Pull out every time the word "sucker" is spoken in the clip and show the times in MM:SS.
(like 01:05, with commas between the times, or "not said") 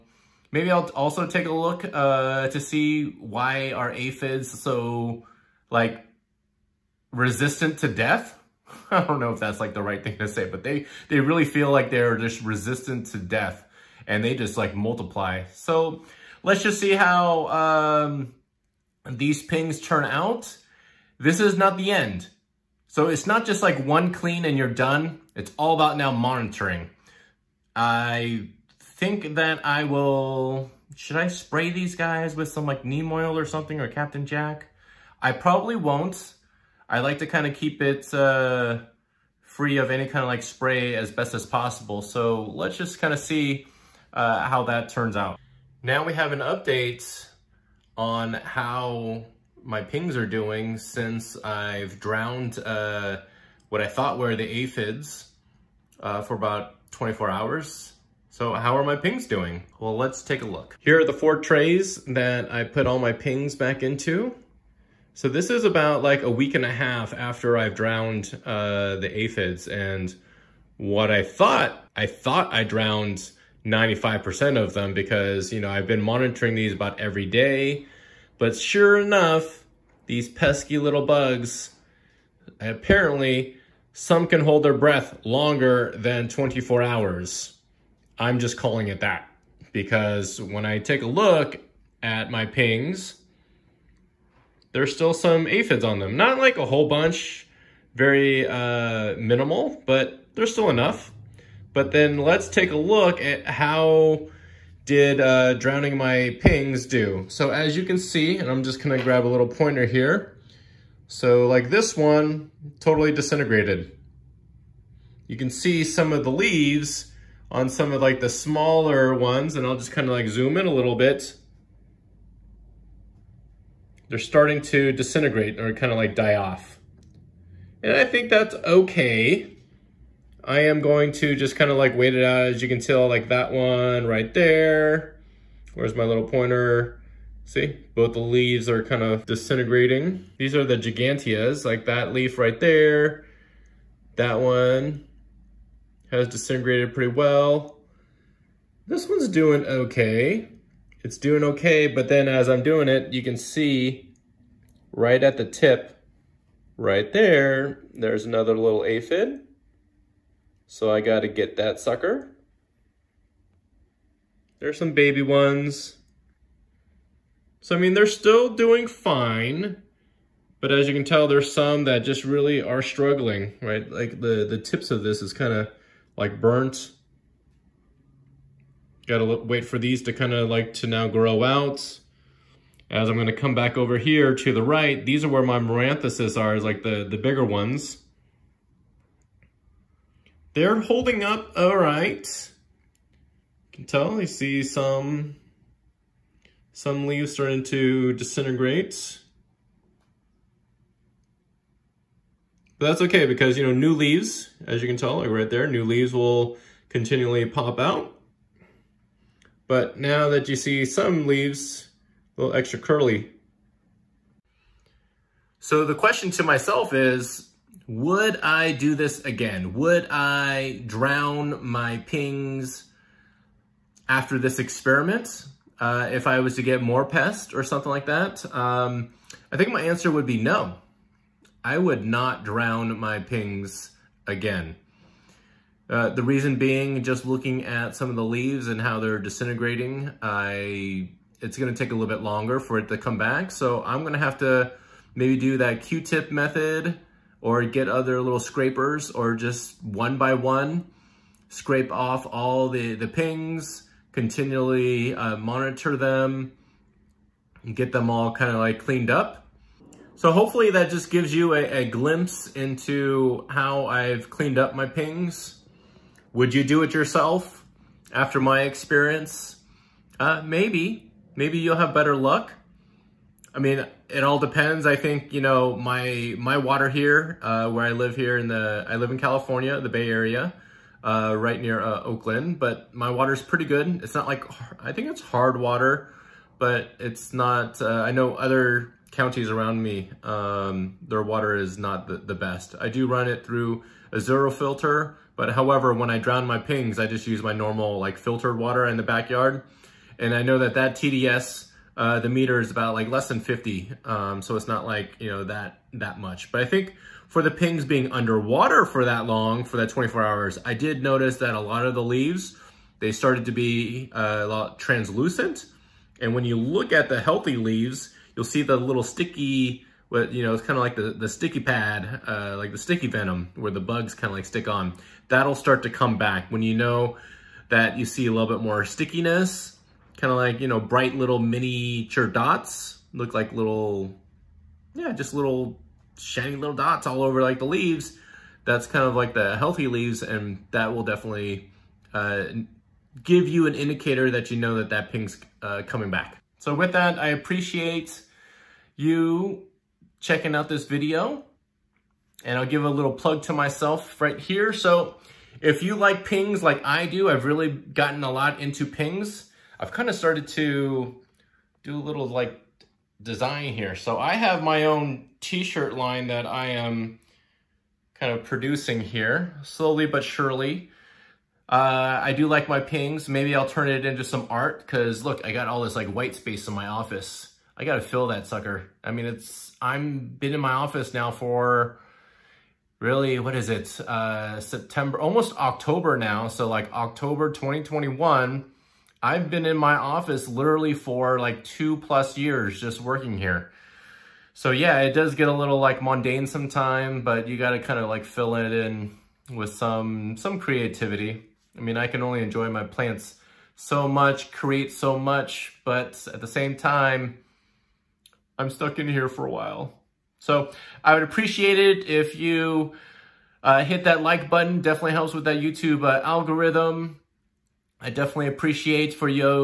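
02:41, 06:18.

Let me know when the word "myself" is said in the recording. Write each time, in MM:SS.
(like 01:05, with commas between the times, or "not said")
03:36, 05:53.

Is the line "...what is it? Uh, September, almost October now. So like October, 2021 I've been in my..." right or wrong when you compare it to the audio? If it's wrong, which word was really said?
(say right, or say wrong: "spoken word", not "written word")
right.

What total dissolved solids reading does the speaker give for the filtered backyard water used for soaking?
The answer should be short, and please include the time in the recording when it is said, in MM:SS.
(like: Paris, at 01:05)
less than 50, at 05:03.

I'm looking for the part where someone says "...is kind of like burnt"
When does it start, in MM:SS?
02:55.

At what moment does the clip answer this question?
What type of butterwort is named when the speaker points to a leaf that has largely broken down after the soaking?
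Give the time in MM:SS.
02:20.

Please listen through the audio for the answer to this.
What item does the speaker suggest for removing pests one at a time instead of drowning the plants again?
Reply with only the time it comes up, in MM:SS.
04:05.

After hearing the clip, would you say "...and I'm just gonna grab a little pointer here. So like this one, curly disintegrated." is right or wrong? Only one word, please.
wrong.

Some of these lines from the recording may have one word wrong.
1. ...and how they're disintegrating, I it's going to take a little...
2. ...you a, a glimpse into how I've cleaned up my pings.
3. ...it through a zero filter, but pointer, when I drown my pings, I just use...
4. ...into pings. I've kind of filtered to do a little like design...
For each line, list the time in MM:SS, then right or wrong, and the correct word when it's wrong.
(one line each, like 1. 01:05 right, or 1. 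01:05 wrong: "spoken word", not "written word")
1. 03:58 right
2. 04:21 right
3. 04:53 wrong: "however", not "pointer"
4. 05:58 wrong: "started", not "filtered".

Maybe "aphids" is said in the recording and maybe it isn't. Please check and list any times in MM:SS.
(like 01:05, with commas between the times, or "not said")
00:03, 00:54, 01:09, 01:35, 02:38.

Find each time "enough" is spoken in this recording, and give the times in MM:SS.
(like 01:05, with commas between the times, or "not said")
01:18, 01:40.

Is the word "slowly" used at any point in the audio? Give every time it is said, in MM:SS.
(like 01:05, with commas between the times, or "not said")
06:09.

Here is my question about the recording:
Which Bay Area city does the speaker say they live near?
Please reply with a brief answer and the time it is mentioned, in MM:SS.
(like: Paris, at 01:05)
Oakland, at 04:42.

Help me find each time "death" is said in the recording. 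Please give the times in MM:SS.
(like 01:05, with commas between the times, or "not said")
00:07, 00:13.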